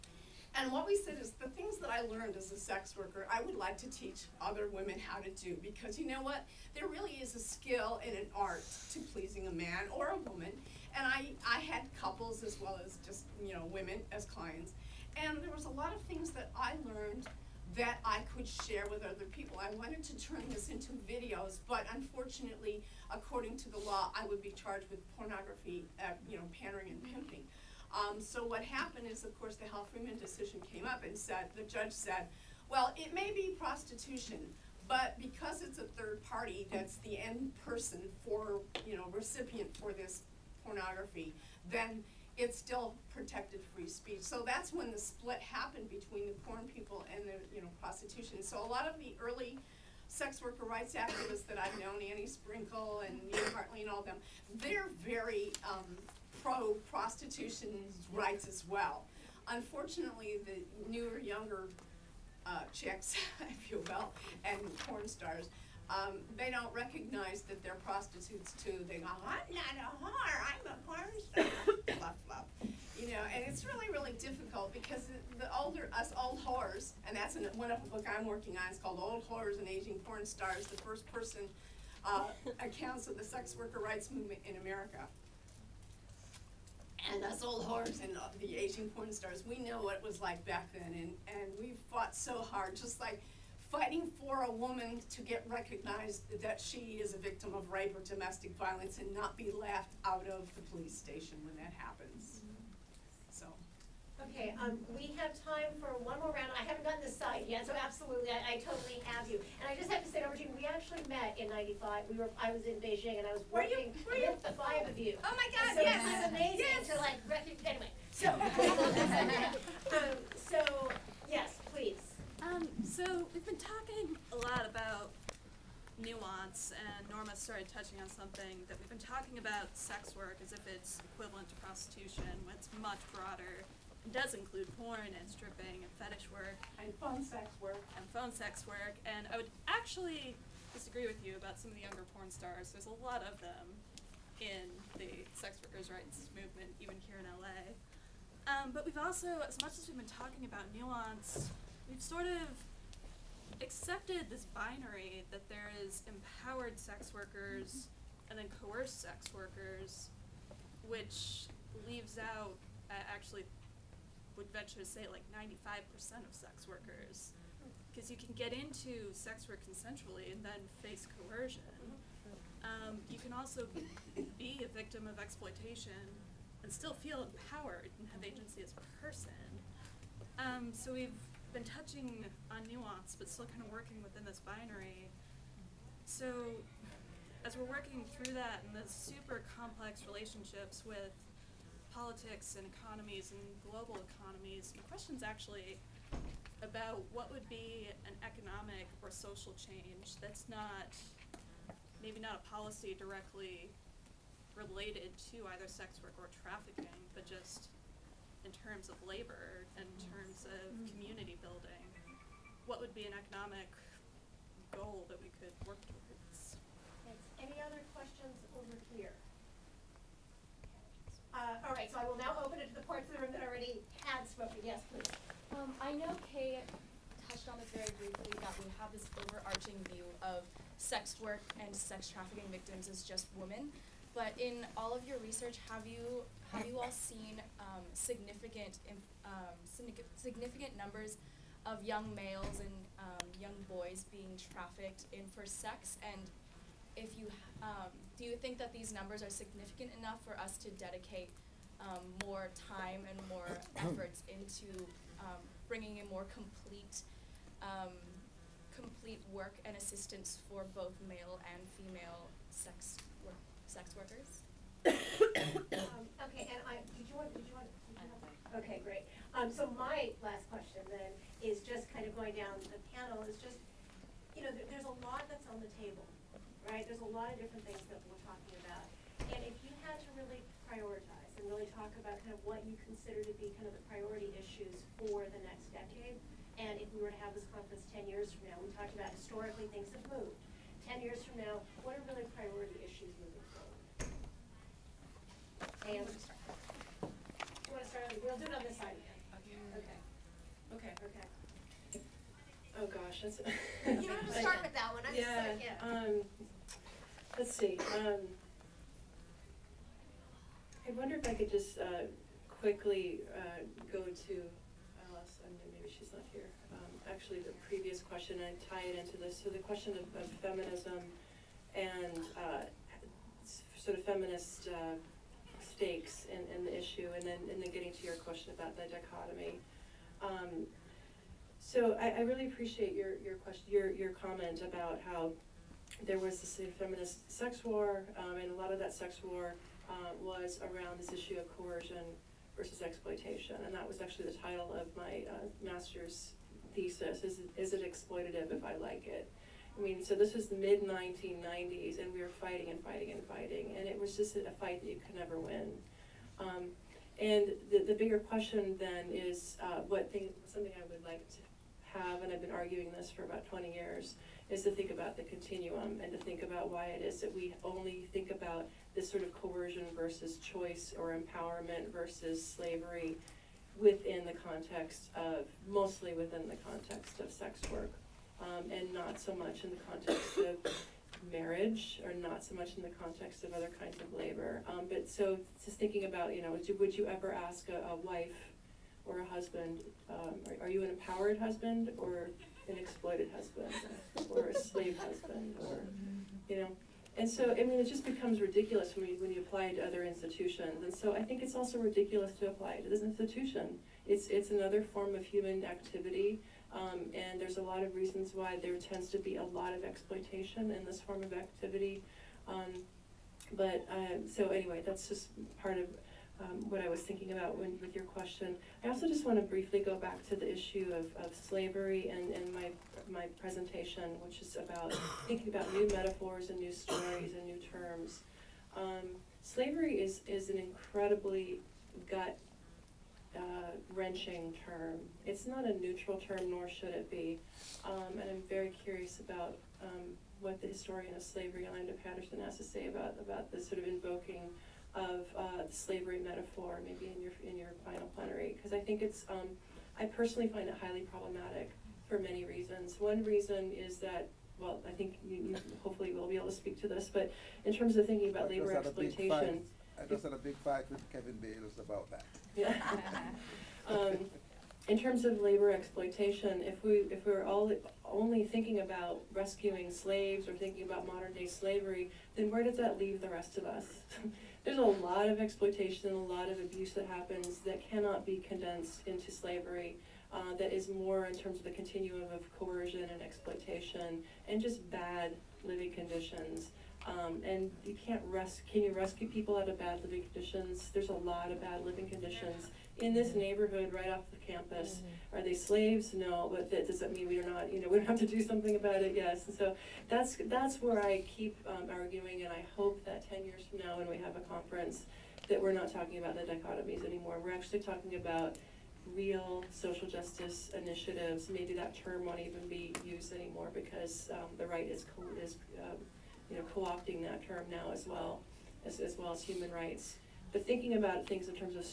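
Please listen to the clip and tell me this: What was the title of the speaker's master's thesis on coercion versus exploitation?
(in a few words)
Is it exploitative if I like it?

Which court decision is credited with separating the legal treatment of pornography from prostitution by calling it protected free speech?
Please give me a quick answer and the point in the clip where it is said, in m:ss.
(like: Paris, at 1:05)
Hal Freeman decision, at 0:29.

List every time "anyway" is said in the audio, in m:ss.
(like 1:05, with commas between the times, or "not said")
1:57, 6:54.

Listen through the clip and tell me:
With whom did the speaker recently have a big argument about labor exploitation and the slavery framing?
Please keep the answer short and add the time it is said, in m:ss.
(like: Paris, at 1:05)
Kevin Bales, at 7:41.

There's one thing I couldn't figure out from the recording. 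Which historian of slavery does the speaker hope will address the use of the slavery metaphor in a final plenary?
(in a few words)
Orlando Patterson.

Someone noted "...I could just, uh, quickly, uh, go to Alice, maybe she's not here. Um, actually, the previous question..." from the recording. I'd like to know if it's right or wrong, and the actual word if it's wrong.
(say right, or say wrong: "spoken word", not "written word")
right.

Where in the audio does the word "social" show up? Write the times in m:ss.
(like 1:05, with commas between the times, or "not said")
3:19, 8:29.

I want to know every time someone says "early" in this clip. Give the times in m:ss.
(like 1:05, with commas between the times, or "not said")
0:49.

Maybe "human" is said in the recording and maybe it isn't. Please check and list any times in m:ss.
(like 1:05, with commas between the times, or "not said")
6:45, 8:39.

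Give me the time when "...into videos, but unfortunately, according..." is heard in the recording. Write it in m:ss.
0:20.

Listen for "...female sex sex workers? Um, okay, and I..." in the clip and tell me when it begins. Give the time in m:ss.
4:21.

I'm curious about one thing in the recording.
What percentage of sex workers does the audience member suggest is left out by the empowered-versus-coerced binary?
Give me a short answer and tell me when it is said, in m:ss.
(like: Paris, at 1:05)
95%, at 2:45.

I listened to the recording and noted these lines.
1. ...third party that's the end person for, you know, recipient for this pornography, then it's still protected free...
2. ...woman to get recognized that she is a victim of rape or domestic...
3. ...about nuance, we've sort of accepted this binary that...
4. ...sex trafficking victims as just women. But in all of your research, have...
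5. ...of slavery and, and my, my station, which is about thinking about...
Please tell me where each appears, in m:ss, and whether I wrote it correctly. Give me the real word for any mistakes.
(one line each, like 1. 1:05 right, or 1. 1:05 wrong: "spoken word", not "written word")
1. 0:35 right
2. 1:34 right
3. 2:30 right
4. 3:51 right
5. 7:01 wrong: "presentation", not "station".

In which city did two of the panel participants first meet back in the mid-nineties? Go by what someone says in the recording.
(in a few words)
Beijing.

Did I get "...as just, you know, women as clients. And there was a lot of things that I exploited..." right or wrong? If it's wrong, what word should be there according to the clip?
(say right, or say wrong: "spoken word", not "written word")
wrong: "learned", not "exploited".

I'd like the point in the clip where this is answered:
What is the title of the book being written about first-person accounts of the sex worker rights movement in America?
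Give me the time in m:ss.
1:18.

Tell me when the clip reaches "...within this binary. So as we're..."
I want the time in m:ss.
3:04.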